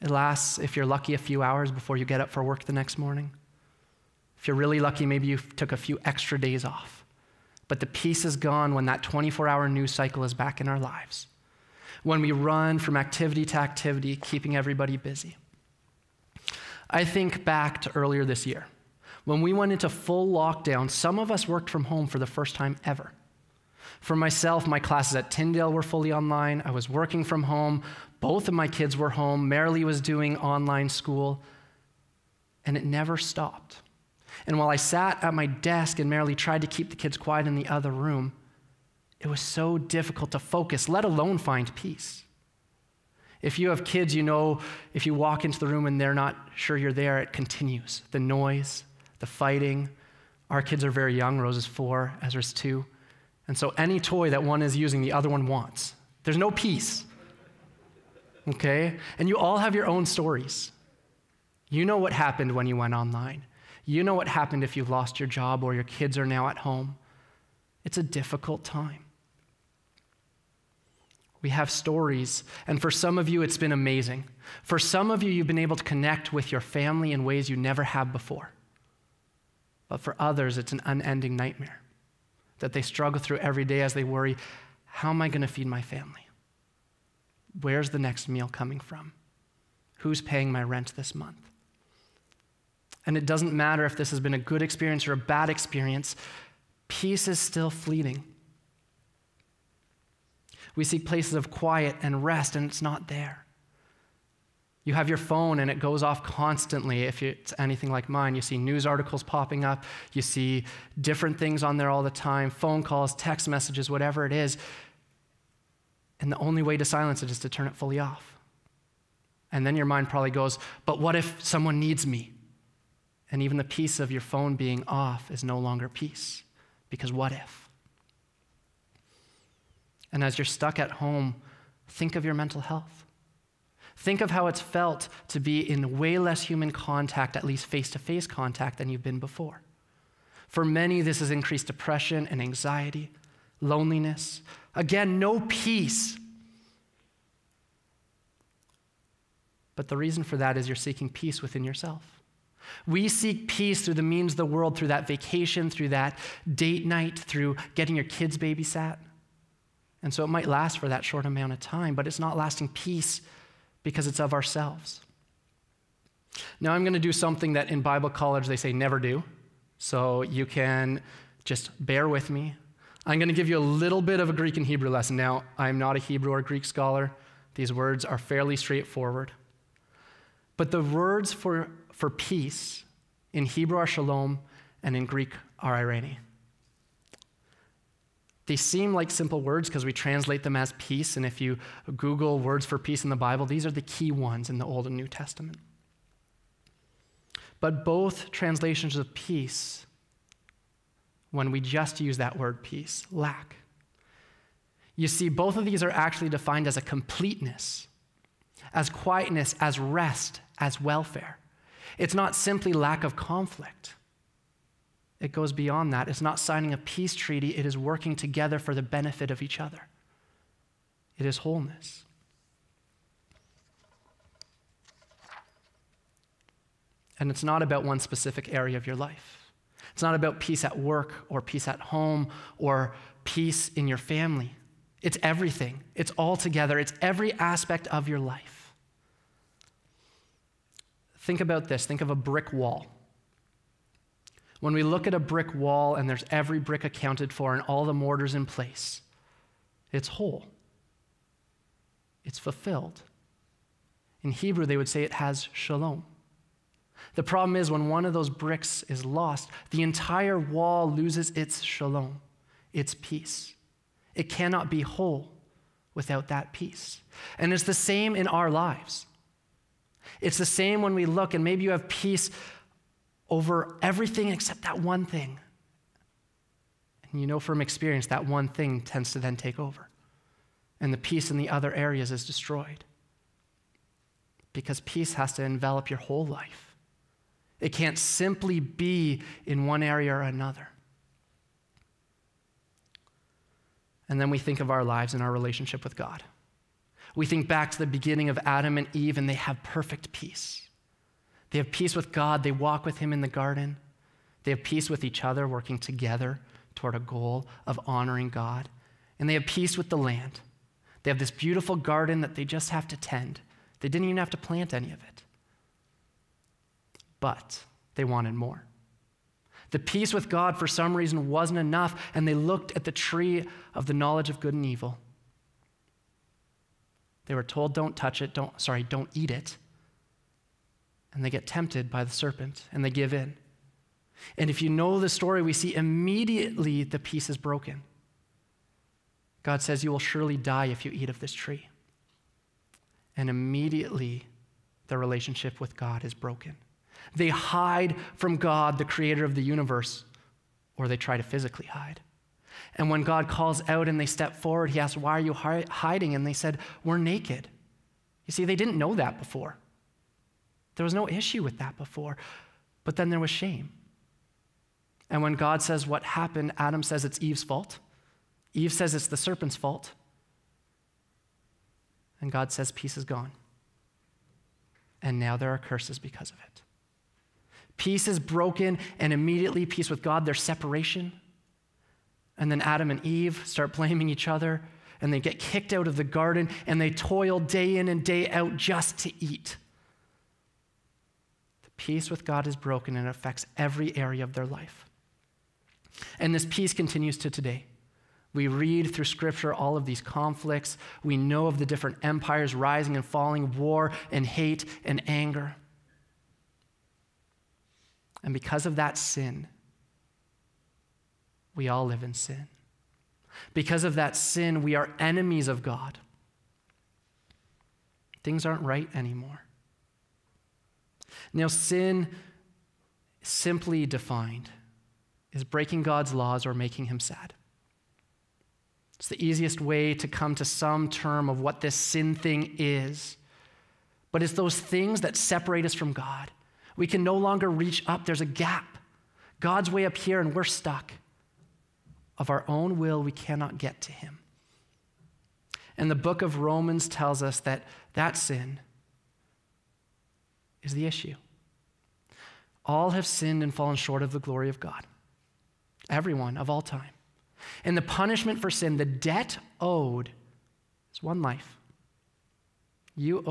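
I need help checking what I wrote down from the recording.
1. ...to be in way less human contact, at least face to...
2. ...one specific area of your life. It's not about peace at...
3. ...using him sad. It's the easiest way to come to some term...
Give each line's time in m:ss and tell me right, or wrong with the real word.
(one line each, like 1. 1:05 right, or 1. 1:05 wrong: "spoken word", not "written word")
1. 2:15 right
2. 3:47 right
3. 7:06 wrong: "making", not "using".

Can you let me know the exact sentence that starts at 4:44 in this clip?
Because peace has to envelop your whole life, it can't simply be in one area or another.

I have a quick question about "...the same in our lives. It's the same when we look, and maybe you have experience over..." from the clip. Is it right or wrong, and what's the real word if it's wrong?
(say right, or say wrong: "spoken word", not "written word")
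wrong: "peace", not "experience".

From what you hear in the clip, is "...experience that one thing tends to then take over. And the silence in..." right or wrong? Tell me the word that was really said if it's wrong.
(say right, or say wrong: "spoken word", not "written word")
wrong: "peace", not "silence".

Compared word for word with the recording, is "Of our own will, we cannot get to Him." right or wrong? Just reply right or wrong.
right.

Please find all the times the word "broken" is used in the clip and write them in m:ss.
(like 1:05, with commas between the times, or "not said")
5:37, 5:46, 6:18, 6:32.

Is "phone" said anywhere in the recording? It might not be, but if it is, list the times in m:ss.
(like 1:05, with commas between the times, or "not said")
1:45, 1:52, 2:04.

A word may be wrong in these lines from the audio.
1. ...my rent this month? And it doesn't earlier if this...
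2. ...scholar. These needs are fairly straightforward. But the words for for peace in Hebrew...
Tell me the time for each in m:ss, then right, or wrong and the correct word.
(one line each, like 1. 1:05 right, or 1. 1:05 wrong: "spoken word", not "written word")
1. 1:30 wrong: "matter", not "earlier"
2. 2:56 wrong: "words", not "needs".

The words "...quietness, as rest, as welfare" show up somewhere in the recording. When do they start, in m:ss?
3:28.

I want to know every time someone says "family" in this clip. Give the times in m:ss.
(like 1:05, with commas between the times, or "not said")
1:16, 1:25, 3:53.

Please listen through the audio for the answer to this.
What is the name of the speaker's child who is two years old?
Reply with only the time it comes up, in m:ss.
0:52.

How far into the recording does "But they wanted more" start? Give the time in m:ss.
5:17.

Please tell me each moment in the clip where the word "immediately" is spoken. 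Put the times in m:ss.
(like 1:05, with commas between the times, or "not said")
5:35, 5:43, 6:19.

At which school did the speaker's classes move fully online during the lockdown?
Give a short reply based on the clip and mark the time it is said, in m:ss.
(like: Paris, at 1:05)
Tyndale, at 0:25.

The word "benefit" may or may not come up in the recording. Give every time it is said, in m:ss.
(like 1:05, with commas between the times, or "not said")
3:38.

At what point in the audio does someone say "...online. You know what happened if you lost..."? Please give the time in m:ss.
1:02.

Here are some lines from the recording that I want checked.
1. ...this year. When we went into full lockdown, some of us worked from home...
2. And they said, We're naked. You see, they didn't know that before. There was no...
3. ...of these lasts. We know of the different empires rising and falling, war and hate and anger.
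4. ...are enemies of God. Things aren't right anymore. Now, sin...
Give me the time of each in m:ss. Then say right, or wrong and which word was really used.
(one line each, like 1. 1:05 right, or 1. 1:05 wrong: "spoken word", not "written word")
1. 0:18 right
2. 5:56 right
3. 6:39 wrong: "conflicts", not "lasts"
4. 6:54 right.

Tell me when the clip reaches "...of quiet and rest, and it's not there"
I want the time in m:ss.
1:41.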